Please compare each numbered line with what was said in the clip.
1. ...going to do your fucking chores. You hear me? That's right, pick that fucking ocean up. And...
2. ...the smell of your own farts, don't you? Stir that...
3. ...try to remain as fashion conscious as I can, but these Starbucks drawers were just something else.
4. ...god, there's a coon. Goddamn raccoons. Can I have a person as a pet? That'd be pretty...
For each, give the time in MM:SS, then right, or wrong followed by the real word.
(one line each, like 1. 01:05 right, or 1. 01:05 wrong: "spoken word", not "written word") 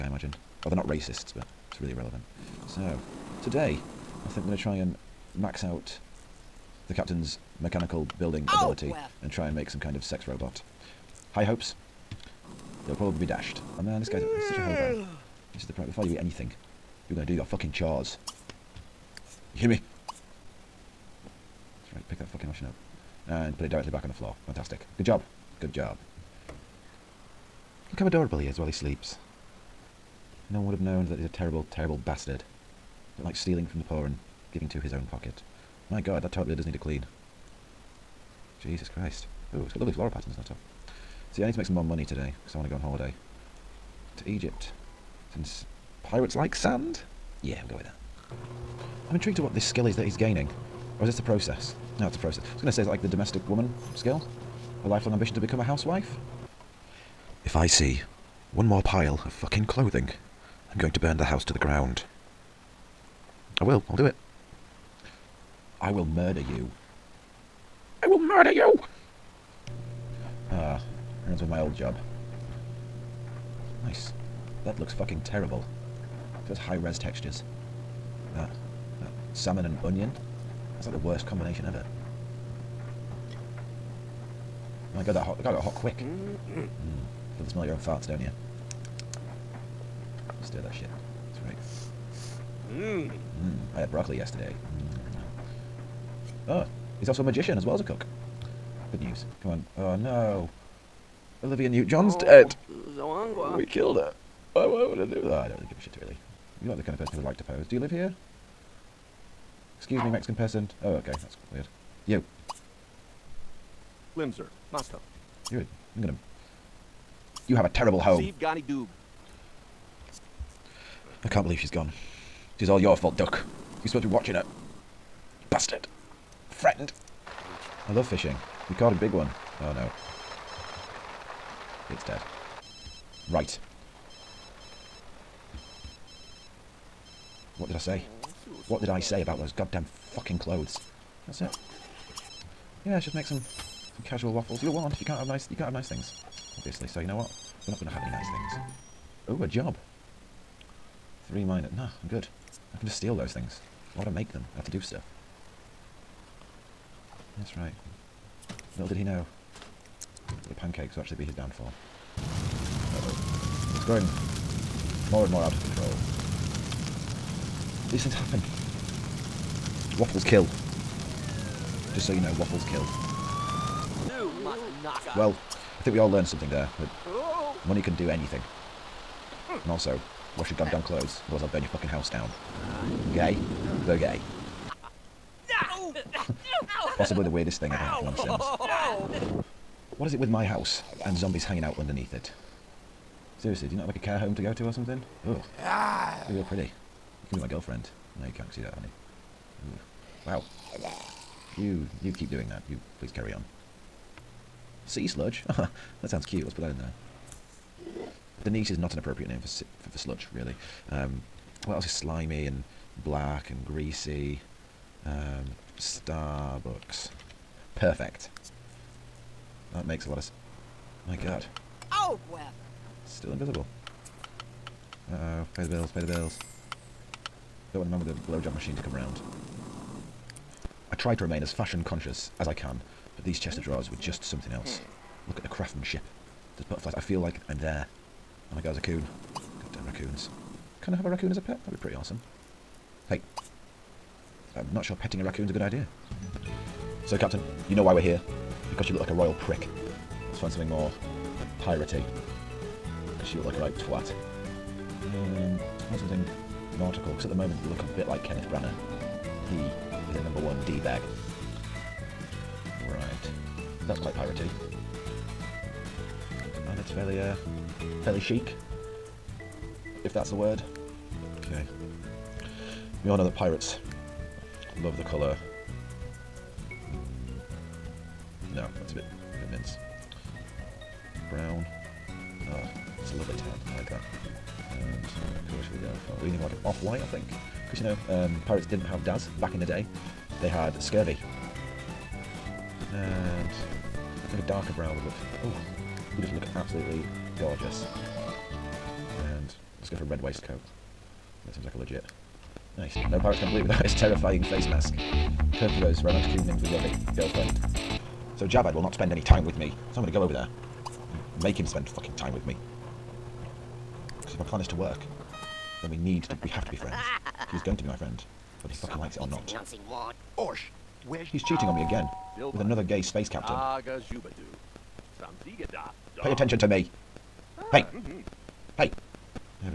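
1. 00:17 right
2. 01:27 right
3. 03:50 wrong: "Chester", not "Starbucks"
4. 03:58 wrong: "raccoon", not "person".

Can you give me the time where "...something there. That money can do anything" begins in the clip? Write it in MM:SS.
02:56.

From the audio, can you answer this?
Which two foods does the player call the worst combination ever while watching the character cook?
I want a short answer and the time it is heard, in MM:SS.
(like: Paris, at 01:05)
Salmon and onion, at 01:19.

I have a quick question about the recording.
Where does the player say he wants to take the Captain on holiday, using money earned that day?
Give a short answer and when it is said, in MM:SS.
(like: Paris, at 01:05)
Egypt, at 00:44.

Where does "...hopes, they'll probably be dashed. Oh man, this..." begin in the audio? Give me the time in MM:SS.
00:11.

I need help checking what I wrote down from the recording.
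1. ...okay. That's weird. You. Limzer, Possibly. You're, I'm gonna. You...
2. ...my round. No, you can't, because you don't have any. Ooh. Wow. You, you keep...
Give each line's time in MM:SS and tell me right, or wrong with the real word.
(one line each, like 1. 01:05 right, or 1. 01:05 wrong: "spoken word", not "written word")
1. 01:50 wrong: "Mosto", not "Possibly"
2. 03:17 wrong: "girlfriend", not "round".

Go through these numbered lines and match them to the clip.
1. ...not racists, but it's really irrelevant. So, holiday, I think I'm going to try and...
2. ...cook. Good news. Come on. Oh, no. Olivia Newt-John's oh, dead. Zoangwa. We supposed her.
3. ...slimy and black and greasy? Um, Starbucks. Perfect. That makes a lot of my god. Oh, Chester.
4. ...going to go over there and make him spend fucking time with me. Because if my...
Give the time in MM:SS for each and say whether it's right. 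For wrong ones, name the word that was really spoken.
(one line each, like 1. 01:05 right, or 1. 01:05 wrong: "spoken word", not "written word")
1. 00:00 wrong: "today", not "holiday"
2. 01:37 wrong: "killed", not "supposed"
3. 03:31 wrong: "Gwen", not "Chester"
4. 05:10 right.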